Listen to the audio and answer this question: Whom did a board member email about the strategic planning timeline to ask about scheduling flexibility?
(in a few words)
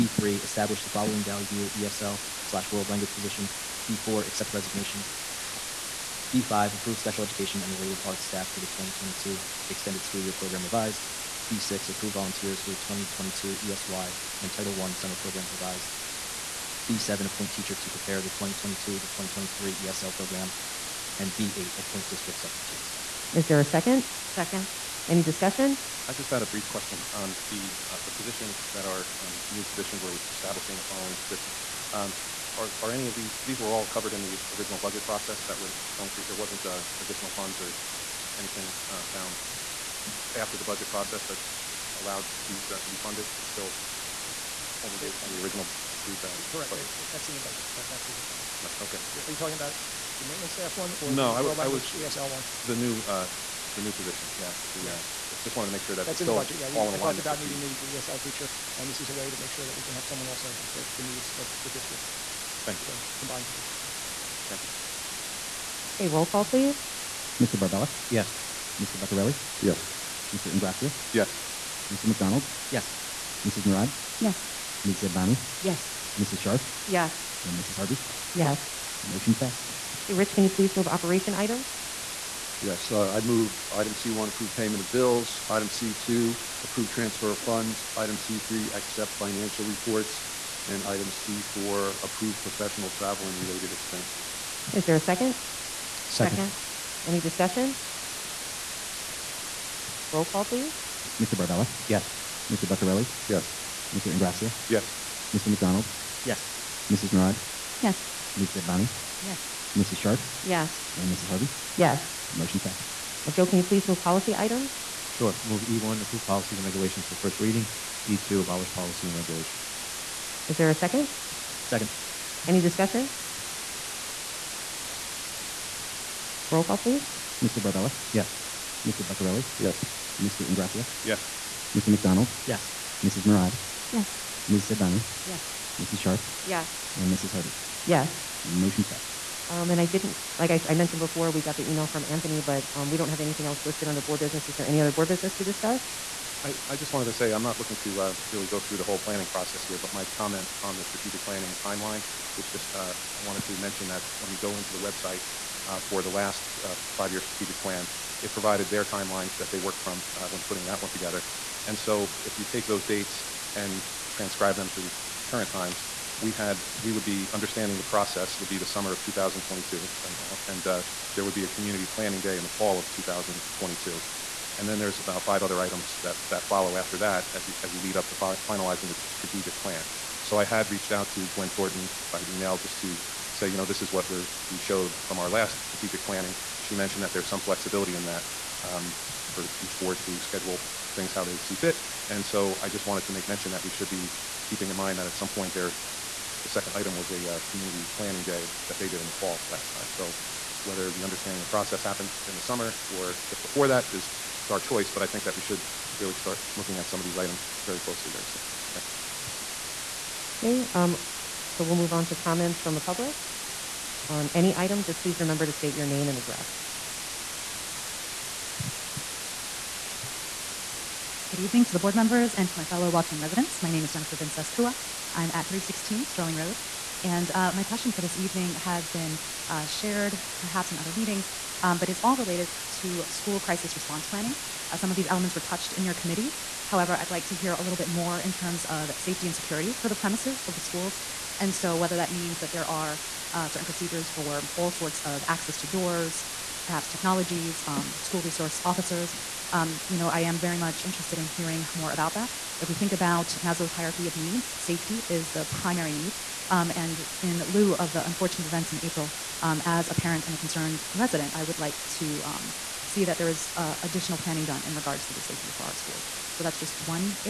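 Gwen Thornton.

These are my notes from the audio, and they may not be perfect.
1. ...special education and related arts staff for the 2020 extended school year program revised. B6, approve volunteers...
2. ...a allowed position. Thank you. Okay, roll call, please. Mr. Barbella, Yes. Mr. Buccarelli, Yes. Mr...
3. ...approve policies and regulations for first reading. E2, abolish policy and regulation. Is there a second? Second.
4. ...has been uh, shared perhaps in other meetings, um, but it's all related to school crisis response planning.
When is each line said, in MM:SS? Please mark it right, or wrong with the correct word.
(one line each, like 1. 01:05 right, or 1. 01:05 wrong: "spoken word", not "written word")
1. 00:06 wrong: "2022", not "2020"
2. 01:03 wrong: "combined", not "allowed"
3. 01:56 right
4. 03:48 right.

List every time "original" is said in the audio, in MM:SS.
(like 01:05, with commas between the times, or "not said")
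00:34, 00:45.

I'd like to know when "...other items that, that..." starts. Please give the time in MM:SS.
02:55.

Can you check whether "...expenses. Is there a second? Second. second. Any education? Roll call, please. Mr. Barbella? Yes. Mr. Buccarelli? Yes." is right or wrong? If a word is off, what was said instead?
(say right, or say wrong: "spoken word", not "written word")
wrong: "discussion", not "education".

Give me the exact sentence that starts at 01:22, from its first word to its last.
Yes, uh, I move item C1, approve payment of bills.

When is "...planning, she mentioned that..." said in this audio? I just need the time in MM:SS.
03:06.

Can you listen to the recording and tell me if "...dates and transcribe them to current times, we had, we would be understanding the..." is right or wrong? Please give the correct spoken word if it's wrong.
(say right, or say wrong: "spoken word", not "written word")
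right.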